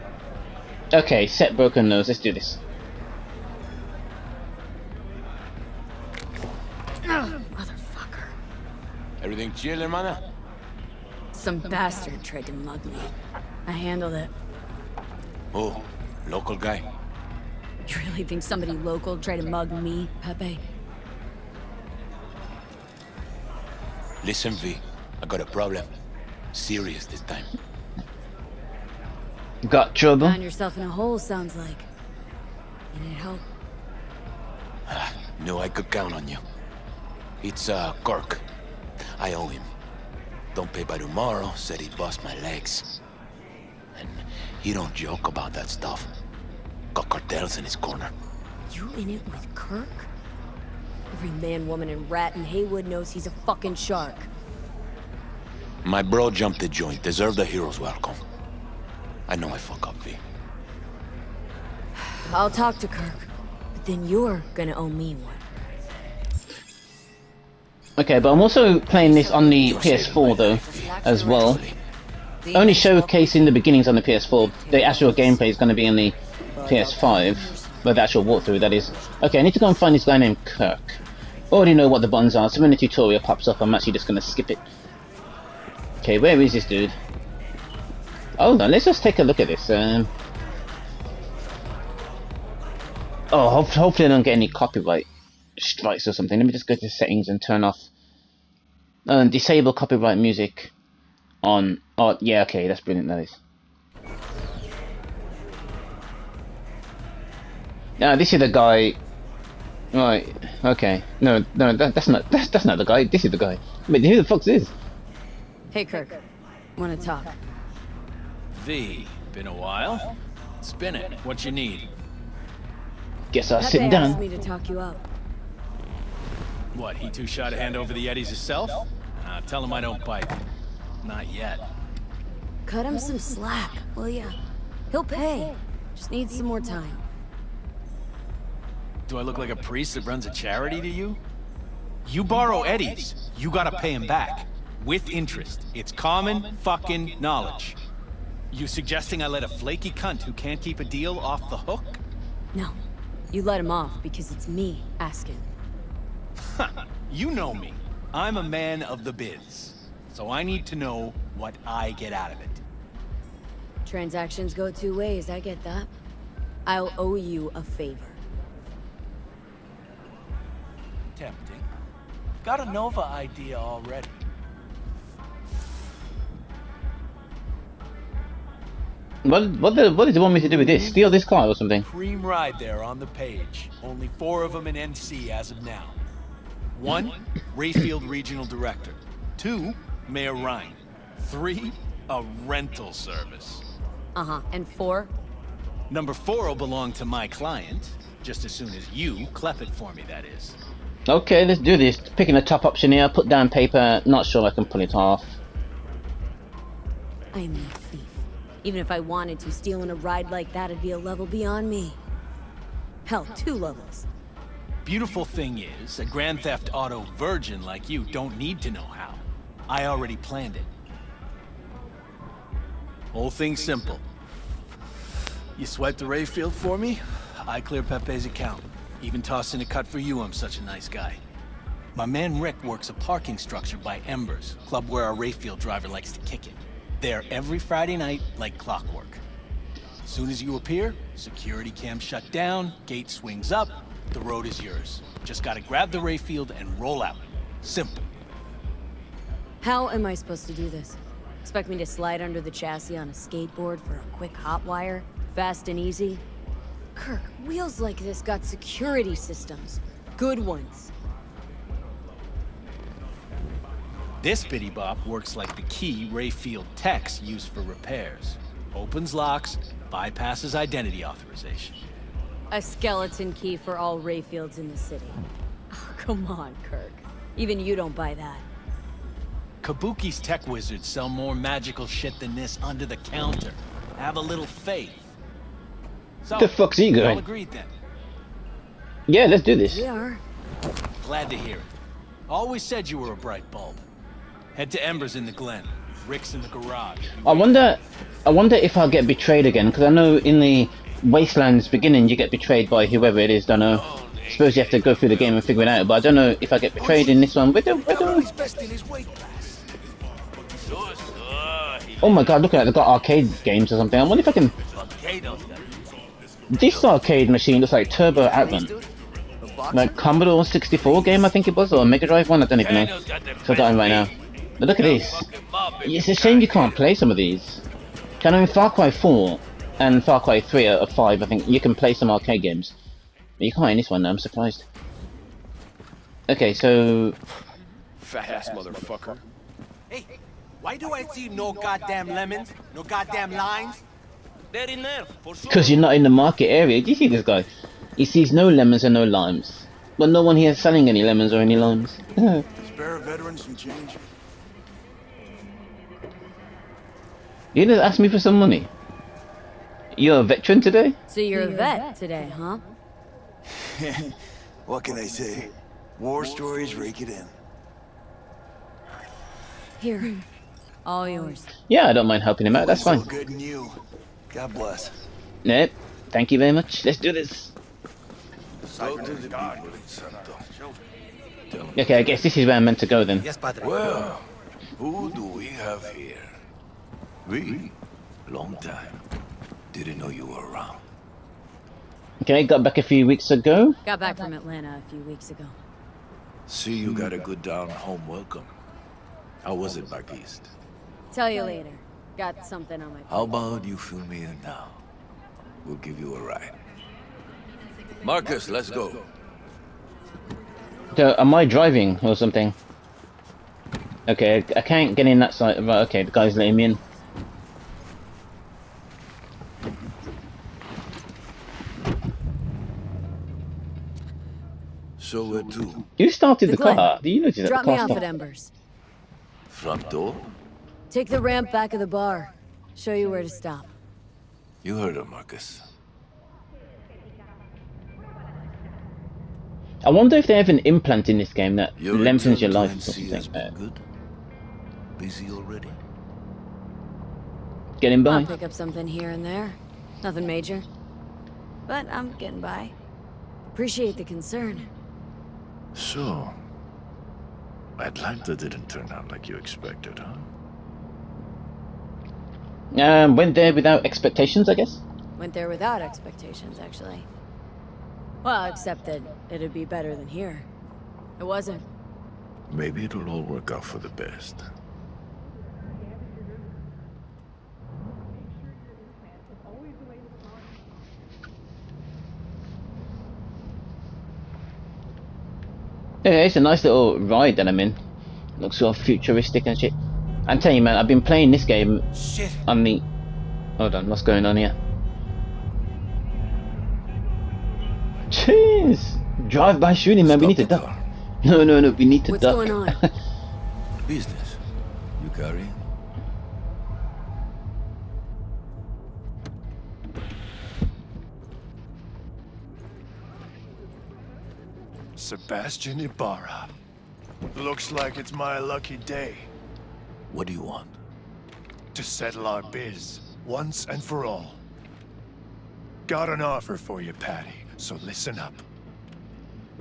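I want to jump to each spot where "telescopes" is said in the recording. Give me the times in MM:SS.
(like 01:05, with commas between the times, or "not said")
not said.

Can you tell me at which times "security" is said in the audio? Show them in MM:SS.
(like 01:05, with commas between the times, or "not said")
04:01, 04:18.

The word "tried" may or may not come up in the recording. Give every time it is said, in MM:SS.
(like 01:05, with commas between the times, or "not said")
00:12, 00:19.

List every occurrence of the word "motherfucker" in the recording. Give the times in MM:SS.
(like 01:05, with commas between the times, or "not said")
00:07, 05:38.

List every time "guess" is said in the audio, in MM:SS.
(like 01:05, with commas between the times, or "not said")
02:03, 06:22, 07:44.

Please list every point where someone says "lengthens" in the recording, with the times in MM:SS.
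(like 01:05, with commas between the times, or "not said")
07:21.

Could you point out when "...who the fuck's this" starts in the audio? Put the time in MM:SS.
01:54.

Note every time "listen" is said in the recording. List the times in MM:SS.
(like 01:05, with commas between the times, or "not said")
00:24, 08:47.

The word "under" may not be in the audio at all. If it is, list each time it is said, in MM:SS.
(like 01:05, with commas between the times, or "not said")
04:12, 04:42.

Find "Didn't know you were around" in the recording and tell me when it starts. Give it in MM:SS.
06:29.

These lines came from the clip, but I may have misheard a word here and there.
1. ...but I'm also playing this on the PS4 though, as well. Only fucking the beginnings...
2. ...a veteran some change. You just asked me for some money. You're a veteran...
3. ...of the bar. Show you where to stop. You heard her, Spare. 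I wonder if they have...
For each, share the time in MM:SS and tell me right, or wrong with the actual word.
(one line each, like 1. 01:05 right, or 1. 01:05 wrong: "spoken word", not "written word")
1. 01:08 wrong: "showcasing", not "fucking"
2. 05:52 right
3. 07:11 wrong: "Marcus", not "Spare".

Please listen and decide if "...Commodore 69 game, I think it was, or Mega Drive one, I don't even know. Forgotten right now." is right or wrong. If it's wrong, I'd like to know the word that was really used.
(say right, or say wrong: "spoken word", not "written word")
wrong: "64", not "69".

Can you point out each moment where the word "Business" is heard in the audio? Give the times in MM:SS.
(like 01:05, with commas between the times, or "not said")
08:23.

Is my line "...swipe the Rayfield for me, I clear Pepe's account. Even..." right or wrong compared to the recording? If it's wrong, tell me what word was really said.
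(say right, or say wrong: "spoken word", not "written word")
right.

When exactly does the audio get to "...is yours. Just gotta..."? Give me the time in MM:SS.
04:04.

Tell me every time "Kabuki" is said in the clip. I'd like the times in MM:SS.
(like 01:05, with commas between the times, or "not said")
04:39.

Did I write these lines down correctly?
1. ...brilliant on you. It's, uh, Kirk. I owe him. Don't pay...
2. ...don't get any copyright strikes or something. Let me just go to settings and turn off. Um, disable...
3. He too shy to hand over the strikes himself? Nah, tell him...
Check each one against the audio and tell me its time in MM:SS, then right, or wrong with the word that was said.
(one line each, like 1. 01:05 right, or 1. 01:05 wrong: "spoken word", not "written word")
1. 00:35 wrong: "count", not "brilliant"
2. 01:34 right
3. 02:06 wrong: "eddies", not "strikes".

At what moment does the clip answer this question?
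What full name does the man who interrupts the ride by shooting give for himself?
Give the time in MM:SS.
08:34.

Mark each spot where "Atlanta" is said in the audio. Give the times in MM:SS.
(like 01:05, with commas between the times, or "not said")
06:34, 07:37.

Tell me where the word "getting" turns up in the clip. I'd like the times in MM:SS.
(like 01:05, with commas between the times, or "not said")
07:27, 07:32.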